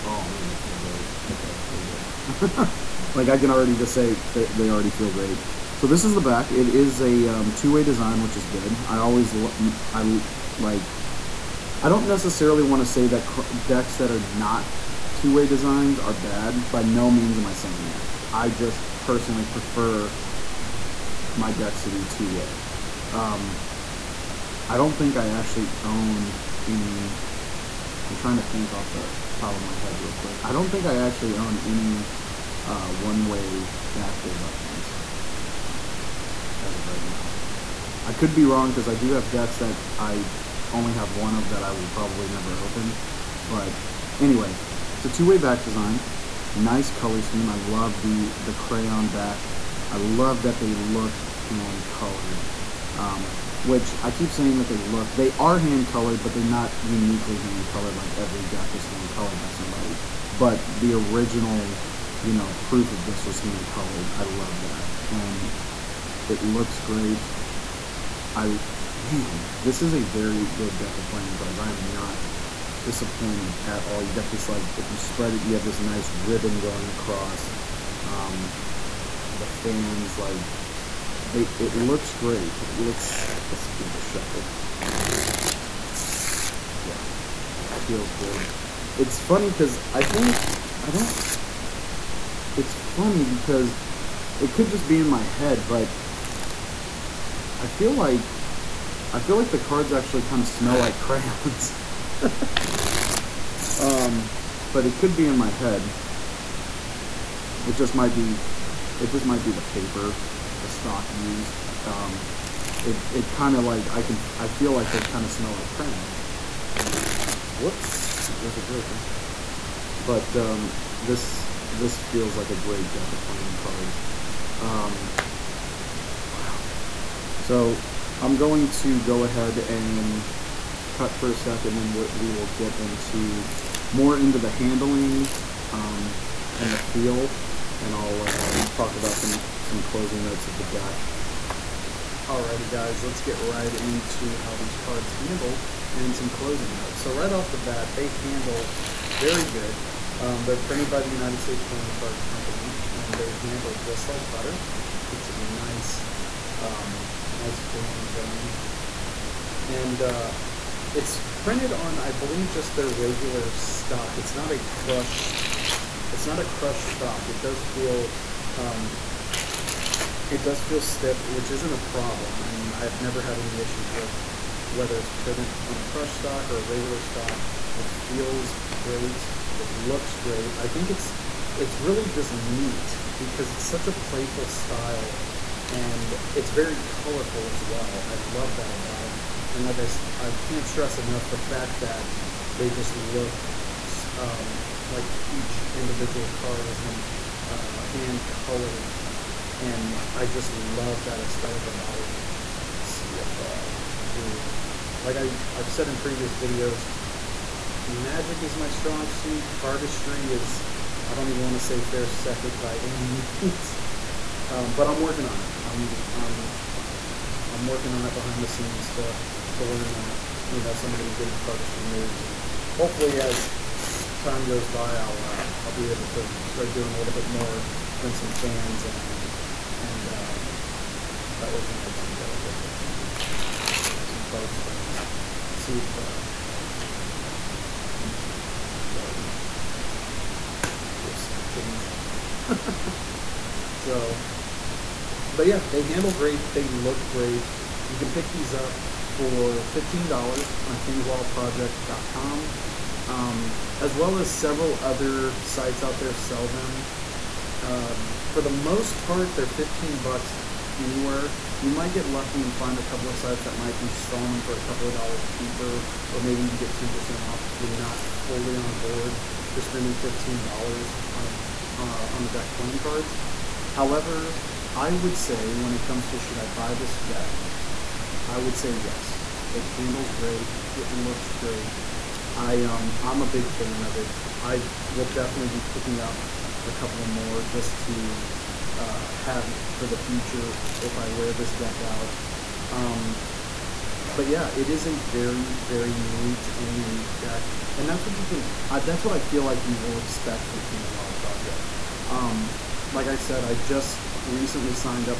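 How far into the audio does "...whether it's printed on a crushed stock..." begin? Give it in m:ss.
2:54.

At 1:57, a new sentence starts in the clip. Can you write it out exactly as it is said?
Whoops, there goes a the joker.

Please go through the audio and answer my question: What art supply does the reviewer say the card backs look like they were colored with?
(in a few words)
Crayon.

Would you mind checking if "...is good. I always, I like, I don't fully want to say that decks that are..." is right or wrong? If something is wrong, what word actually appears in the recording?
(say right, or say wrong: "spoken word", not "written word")
wrong: "necessarily", not "fully".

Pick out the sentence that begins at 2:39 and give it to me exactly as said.
And uh, it's printed on, I believe, just their regular stock.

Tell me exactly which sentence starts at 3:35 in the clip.
I'm, I'm, I'm working on it behind the scenes to, to learn, uh, you know, some of the beginner cardistry moves.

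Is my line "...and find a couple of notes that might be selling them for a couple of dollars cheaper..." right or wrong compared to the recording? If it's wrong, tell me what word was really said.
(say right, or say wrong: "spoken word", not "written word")
wrong: "sites", not "notes".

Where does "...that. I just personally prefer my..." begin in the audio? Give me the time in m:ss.
0:17.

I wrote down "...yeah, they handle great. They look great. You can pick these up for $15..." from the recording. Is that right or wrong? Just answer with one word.
right.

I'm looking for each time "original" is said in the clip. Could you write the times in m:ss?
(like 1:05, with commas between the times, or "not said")
1:00.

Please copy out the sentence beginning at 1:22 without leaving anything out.
Let's, let's give it a shuffle.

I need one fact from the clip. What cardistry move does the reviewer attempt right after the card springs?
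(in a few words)
Snap change.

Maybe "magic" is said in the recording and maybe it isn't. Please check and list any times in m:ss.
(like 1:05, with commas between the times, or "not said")
3:27.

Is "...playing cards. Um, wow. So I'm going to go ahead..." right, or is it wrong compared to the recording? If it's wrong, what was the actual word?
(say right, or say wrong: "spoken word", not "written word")
right.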